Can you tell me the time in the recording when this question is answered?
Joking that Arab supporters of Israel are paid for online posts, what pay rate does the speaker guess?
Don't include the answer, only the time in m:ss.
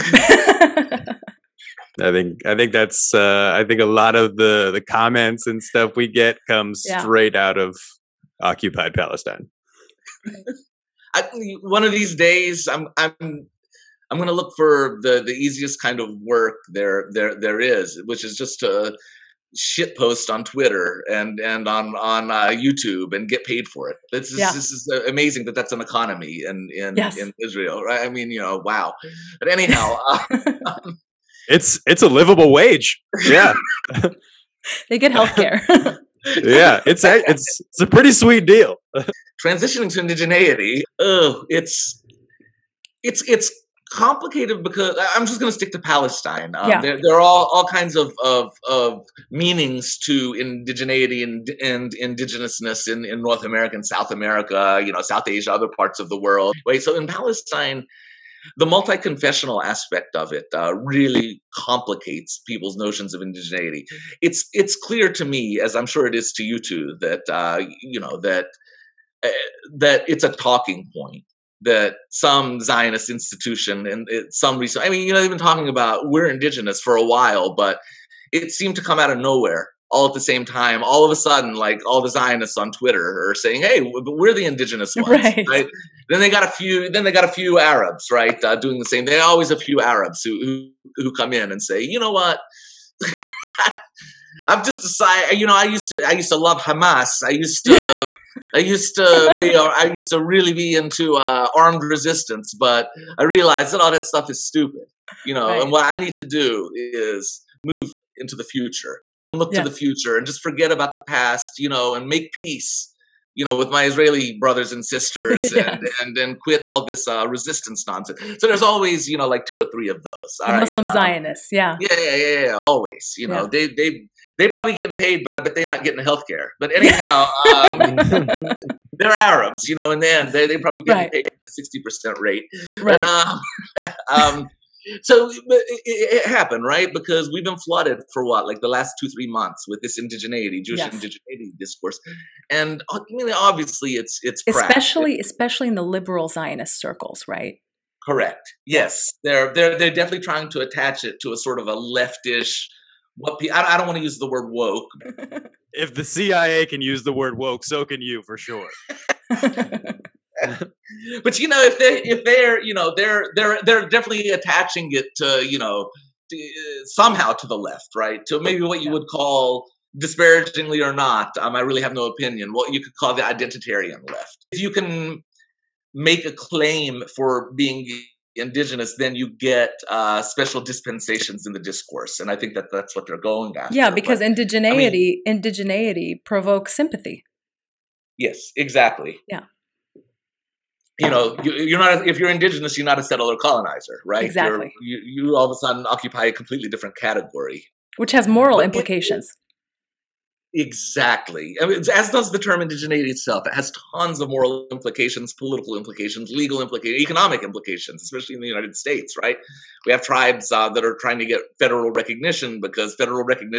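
2:11.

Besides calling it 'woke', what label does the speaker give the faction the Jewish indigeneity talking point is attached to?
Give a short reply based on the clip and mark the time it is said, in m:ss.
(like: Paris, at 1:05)
the identitarian left, at 2:53.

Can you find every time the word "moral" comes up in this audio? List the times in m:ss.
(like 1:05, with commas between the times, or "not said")
3:18, 3:24.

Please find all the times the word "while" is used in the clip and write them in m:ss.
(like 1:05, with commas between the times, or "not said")
1:17.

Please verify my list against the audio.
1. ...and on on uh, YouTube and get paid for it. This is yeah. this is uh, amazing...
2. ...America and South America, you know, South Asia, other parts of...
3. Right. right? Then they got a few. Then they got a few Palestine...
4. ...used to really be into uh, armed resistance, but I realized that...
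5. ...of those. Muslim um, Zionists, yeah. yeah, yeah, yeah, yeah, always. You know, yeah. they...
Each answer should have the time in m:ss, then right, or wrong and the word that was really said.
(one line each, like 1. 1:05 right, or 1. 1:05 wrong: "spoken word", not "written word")
1. 0:21 right
2. 0:53 right
3. 1:25 wrong: "Arabs", not "Palestine"
4. 1:39 right
5. 1:59 right.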